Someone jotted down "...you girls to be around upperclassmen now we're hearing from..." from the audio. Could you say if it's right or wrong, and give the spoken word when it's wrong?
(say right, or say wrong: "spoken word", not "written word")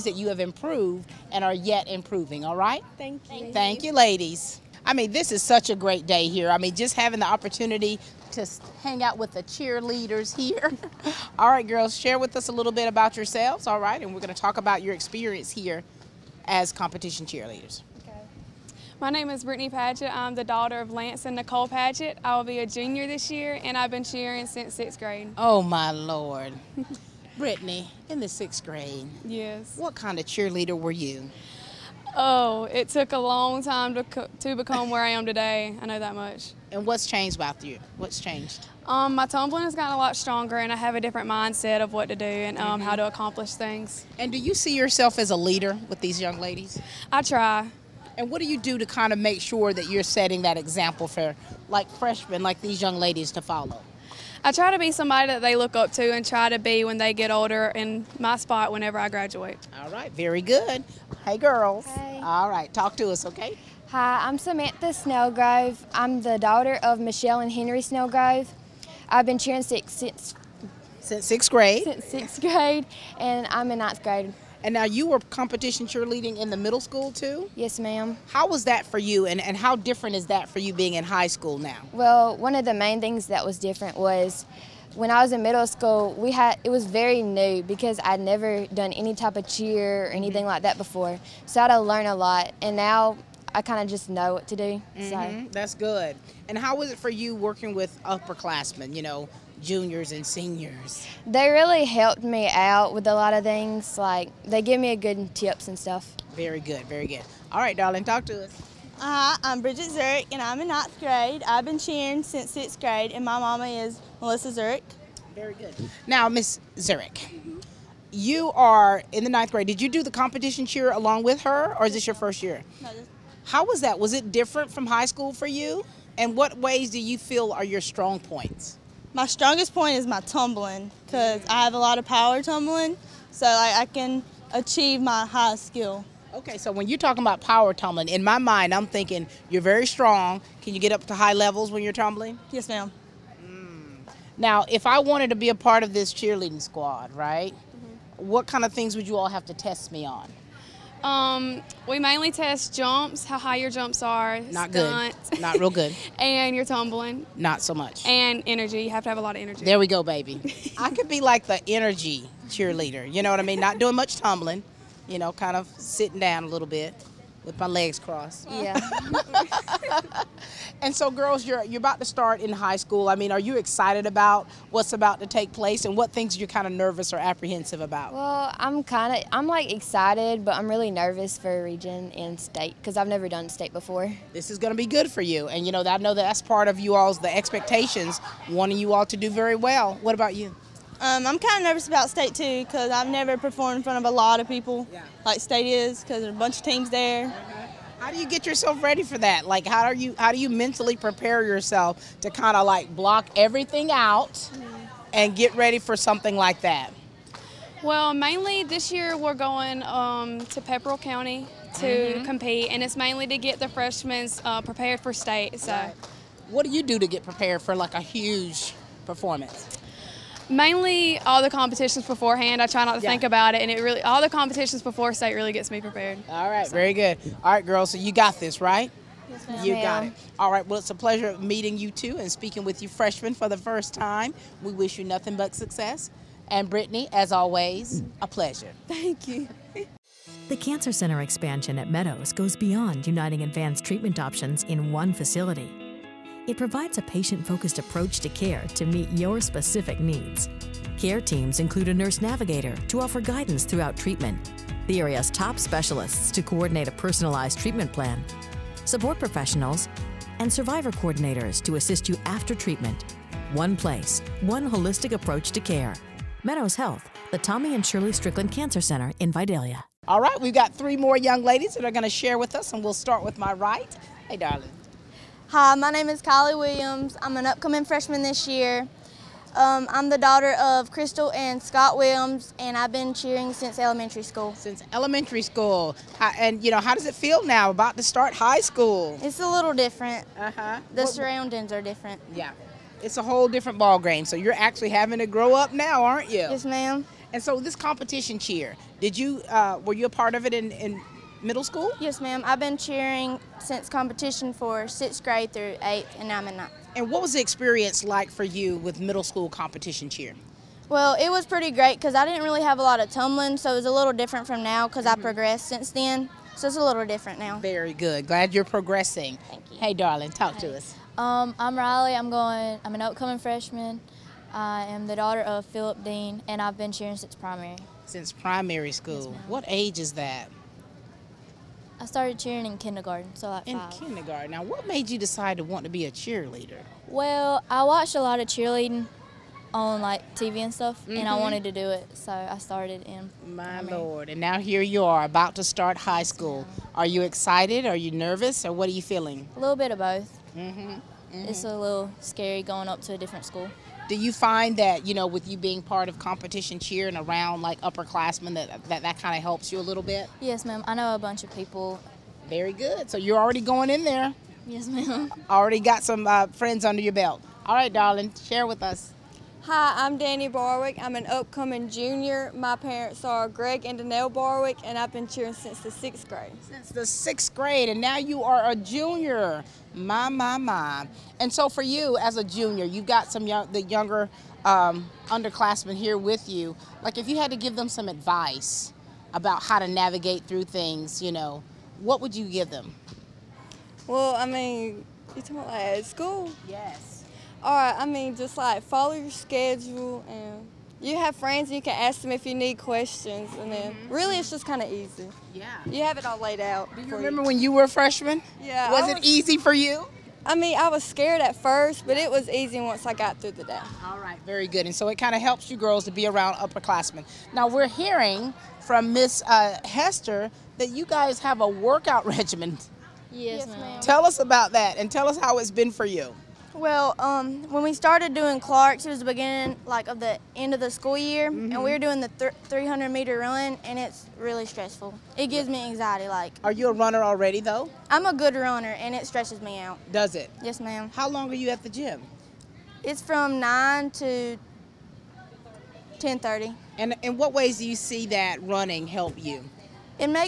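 right.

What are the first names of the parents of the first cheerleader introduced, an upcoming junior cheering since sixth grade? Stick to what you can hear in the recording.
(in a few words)
Lance and Nicole.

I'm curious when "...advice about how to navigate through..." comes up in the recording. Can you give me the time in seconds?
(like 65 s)
388 s.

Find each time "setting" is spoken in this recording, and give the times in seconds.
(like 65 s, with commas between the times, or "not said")
50 s.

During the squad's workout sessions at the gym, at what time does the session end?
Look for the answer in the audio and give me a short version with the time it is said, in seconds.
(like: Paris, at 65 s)
10:30, at 446 s.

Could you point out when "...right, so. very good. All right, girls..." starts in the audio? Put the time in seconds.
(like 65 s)
226 s.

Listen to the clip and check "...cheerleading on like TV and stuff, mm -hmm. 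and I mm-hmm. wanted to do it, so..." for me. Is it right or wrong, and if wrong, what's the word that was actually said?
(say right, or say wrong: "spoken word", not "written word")
right.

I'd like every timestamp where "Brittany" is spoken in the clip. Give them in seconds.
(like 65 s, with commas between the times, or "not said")
19 s, 27 s, 236 s.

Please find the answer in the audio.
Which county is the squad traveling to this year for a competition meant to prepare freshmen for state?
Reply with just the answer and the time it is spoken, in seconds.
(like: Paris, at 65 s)
Pepperell County, at 210 s.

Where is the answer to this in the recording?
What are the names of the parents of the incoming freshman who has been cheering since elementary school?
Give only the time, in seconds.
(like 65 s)
280 s.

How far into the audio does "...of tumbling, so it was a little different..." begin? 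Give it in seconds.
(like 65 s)
312 s.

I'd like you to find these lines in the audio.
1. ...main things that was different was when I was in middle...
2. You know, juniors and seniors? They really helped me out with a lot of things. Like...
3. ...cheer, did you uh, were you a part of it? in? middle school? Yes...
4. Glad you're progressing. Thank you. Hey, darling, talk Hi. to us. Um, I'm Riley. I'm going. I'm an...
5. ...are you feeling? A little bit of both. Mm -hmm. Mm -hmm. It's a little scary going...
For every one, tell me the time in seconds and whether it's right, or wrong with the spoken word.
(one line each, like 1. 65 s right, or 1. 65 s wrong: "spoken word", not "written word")
1. 82 s right
2. 98 s right
3. 298 s right
4. 318 s right
5. 348 s right.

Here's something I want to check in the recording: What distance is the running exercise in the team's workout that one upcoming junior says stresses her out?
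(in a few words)
300 meters.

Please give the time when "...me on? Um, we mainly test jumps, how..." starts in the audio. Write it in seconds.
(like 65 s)
149 s.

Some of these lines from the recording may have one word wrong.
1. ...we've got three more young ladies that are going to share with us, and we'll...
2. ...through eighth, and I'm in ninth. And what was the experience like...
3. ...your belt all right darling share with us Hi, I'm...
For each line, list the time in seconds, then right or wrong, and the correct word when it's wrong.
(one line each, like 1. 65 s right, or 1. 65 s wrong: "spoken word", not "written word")
1. 270 s right
2. 305 s right
3. 367 s right.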